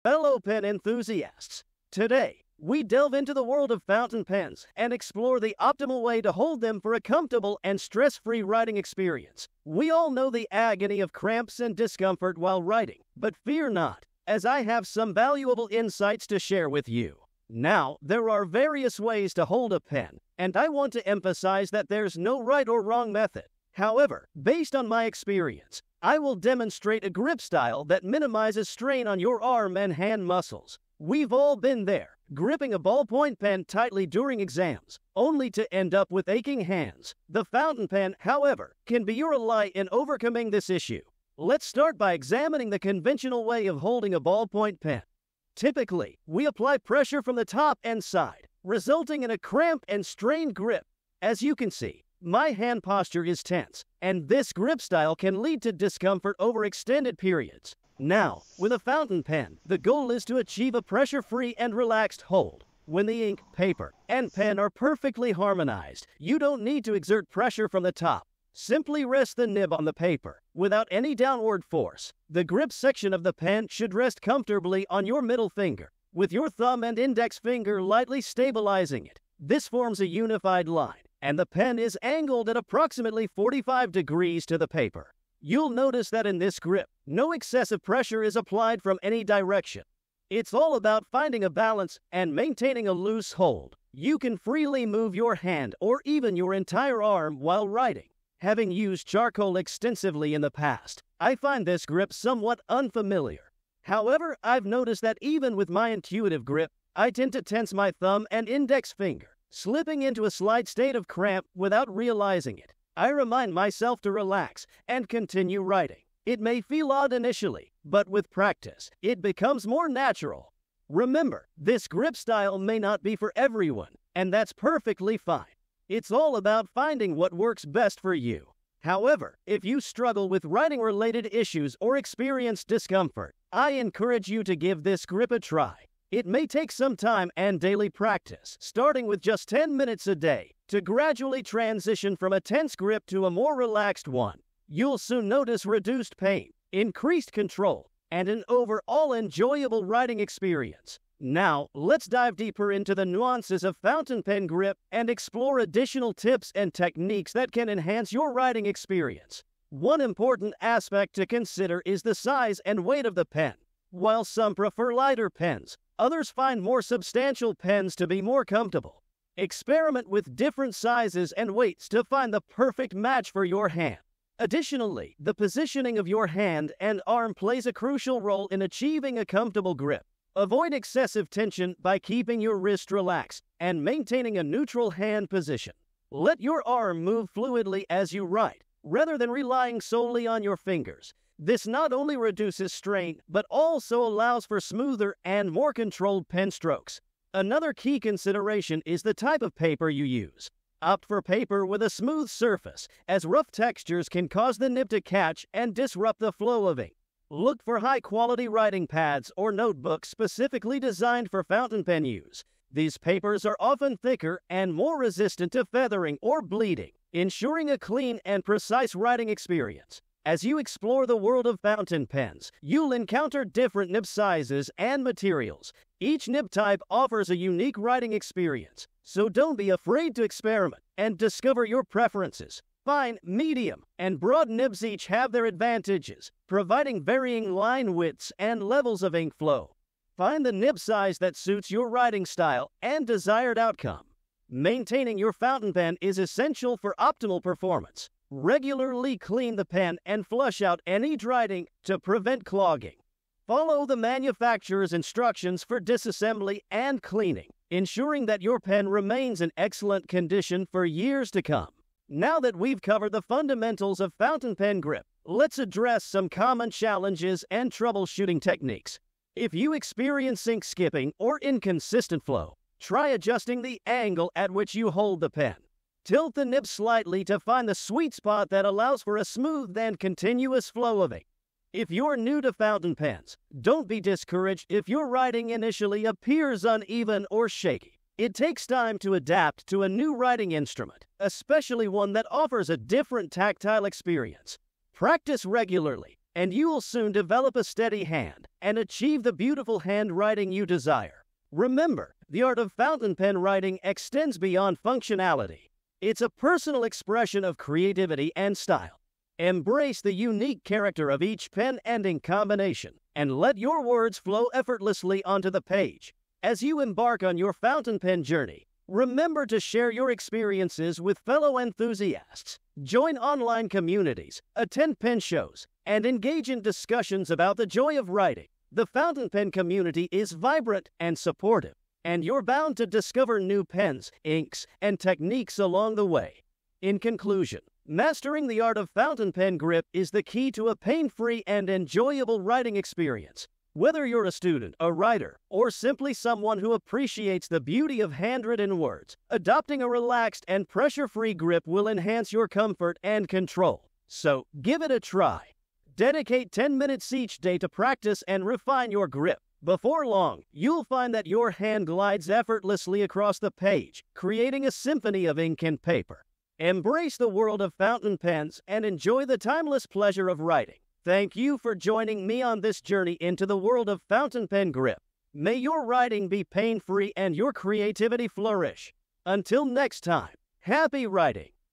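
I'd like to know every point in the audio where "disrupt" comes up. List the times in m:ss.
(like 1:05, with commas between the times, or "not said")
3:25.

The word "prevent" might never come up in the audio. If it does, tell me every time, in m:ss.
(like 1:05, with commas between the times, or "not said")
4:11.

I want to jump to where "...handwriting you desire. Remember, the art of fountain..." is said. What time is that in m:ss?
4:59.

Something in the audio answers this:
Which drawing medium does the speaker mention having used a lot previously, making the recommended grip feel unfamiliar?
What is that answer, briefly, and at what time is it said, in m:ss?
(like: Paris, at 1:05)
Charcoal, at 1:39.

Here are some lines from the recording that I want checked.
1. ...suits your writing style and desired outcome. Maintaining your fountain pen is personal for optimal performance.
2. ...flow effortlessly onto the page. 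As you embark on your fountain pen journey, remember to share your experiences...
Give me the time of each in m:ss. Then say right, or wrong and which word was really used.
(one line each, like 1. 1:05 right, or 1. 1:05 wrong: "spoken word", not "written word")
1. 4:01 wrong: "essential", not "personal"
2. 5:14 right.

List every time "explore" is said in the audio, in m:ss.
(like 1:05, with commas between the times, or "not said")
0:04, 2:35, 3:40.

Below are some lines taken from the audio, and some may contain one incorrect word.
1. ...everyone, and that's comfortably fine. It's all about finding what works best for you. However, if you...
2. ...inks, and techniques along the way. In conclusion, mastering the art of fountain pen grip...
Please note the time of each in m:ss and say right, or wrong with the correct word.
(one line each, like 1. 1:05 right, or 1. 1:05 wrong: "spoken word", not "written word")
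1. 2:03 wrong: "perfectly", not "comfortably"
2. 5:34 right.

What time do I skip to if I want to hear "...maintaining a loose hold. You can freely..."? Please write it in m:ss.
1:32.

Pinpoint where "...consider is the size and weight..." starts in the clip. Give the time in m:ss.
2:41.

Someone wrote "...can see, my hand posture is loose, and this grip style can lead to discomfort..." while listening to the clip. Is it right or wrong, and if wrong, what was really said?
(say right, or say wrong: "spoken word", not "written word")
wrong: "tense", not "loose".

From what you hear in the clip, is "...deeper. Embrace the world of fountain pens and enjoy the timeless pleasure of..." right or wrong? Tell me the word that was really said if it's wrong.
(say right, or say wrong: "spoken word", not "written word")
wrong: "paper", not "deeper".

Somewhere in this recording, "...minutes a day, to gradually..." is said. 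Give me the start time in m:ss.
2:19.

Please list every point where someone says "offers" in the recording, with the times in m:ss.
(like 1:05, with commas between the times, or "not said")
3:46, 4:52.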